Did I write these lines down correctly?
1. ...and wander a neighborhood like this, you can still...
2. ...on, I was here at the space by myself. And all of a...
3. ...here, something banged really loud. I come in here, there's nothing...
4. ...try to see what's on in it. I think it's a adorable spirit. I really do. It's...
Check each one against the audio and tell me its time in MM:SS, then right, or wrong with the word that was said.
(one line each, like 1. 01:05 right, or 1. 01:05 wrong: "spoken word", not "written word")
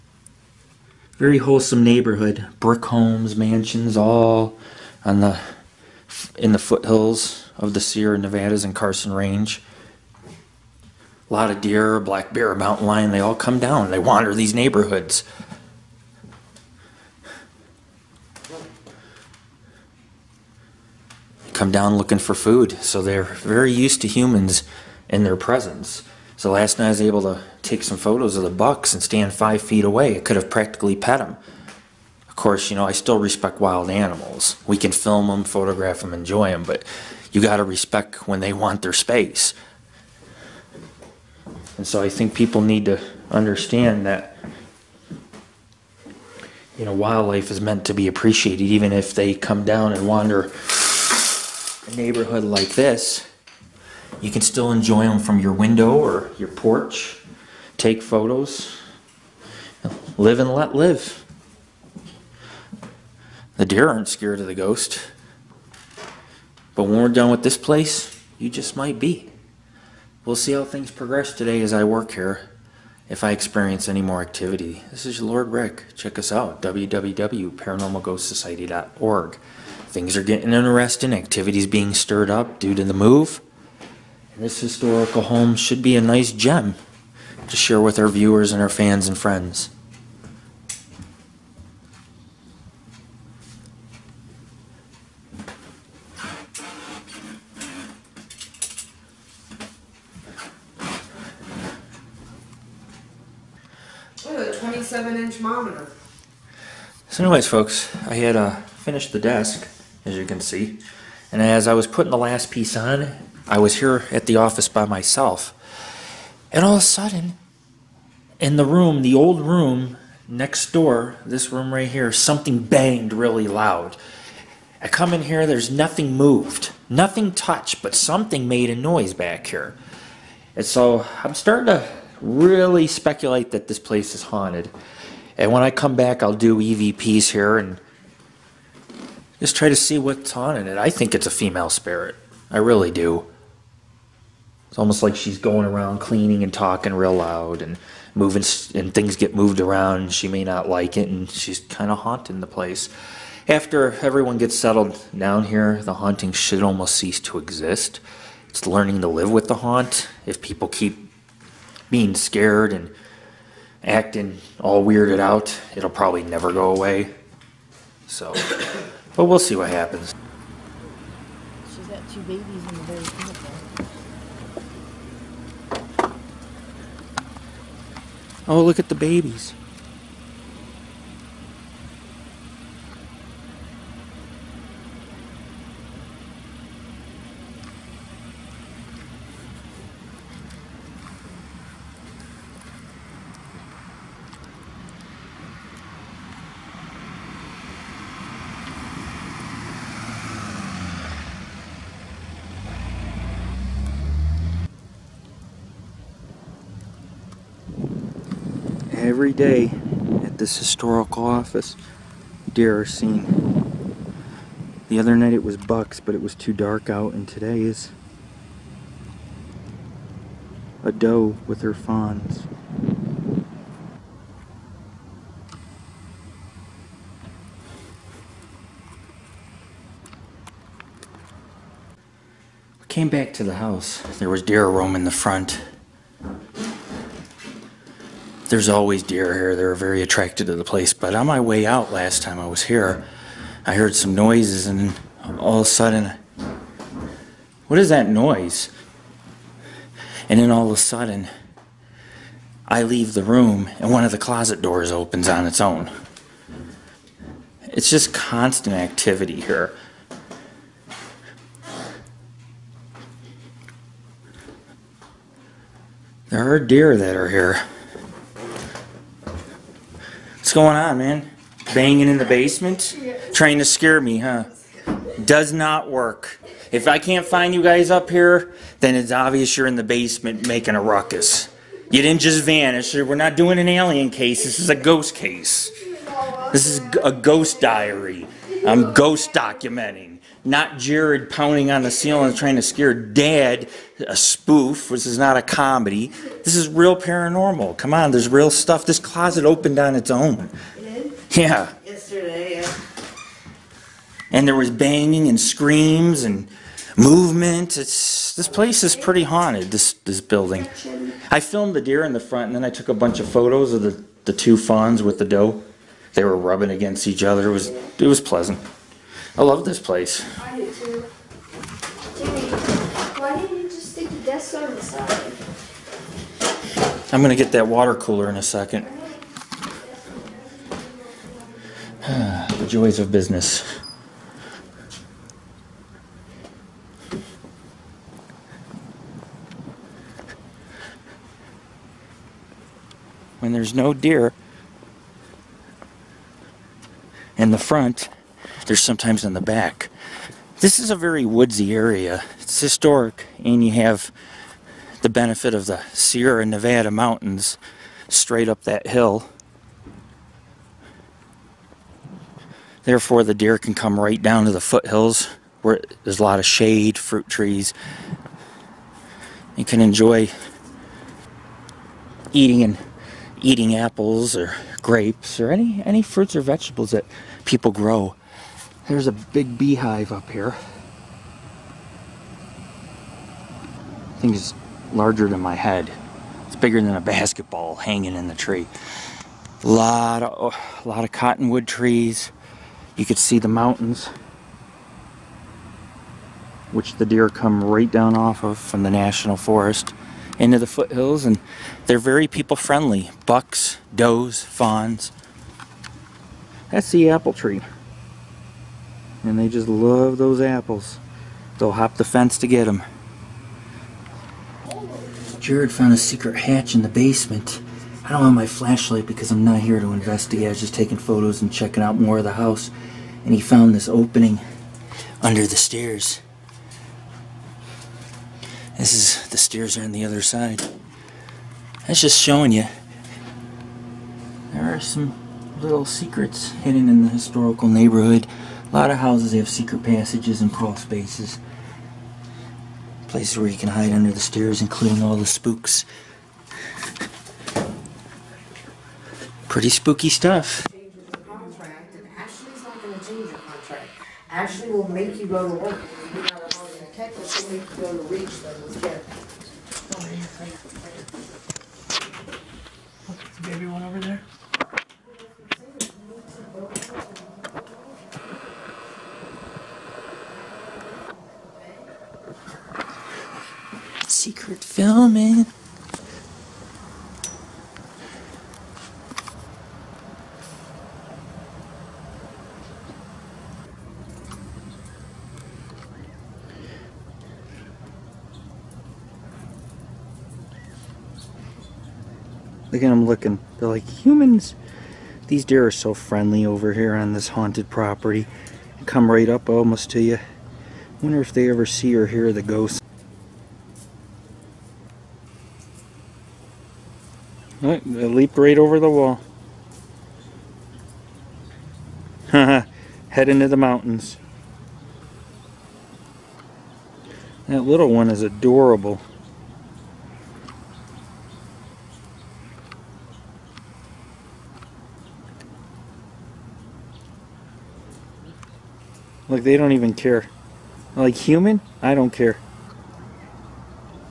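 1. 00:49 right
2. 01:52 wrong: "office", not "space"
3. 02:01 right
4. 02:19 wrong: "female", not "adorable".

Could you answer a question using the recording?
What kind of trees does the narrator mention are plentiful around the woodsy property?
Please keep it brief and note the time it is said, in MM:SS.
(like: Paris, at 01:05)
cottonwood trees, at 06:31.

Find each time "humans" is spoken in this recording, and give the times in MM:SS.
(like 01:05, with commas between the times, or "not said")
00:24, 08:13, 08:51.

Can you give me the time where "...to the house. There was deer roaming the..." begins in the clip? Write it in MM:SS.
03:53.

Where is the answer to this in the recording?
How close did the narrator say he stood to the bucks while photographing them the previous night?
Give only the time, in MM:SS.
00:29.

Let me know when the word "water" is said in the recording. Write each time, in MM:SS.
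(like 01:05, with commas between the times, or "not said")
05:27.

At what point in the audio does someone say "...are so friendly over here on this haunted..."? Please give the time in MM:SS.
08:15.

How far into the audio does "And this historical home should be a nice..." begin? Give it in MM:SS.
01:24.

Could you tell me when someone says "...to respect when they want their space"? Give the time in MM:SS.
00:37.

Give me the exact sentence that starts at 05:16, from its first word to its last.
They were rubbing against each other.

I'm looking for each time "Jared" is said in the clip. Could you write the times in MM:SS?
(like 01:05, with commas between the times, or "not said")
04:50, 06:55.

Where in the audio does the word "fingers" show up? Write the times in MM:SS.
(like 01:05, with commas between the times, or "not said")
not said.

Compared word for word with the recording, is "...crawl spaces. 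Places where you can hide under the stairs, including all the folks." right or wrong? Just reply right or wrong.
wrong.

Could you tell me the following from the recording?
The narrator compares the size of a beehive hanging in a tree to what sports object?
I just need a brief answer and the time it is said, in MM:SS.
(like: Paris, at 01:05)
a basketball, at 06:27.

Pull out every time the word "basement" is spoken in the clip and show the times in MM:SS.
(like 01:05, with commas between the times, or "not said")
04:32, 04:39, 06:56.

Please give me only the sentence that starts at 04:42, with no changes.
We're not doing an alien case.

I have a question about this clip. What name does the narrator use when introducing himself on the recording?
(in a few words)
Lord Rick.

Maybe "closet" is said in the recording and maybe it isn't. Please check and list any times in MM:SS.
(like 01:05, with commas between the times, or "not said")
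04:14, 04:58.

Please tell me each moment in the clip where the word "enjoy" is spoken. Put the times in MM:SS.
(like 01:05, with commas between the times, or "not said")
00:36, 00:54, 06:09.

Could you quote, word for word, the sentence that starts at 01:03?
The deer aren't scared of the ghost.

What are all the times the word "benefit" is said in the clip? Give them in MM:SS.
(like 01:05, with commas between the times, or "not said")
05:55.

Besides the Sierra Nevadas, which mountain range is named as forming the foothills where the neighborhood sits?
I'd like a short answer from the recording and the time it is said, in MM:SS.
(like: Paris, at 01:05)
Carson Range, at 00:08.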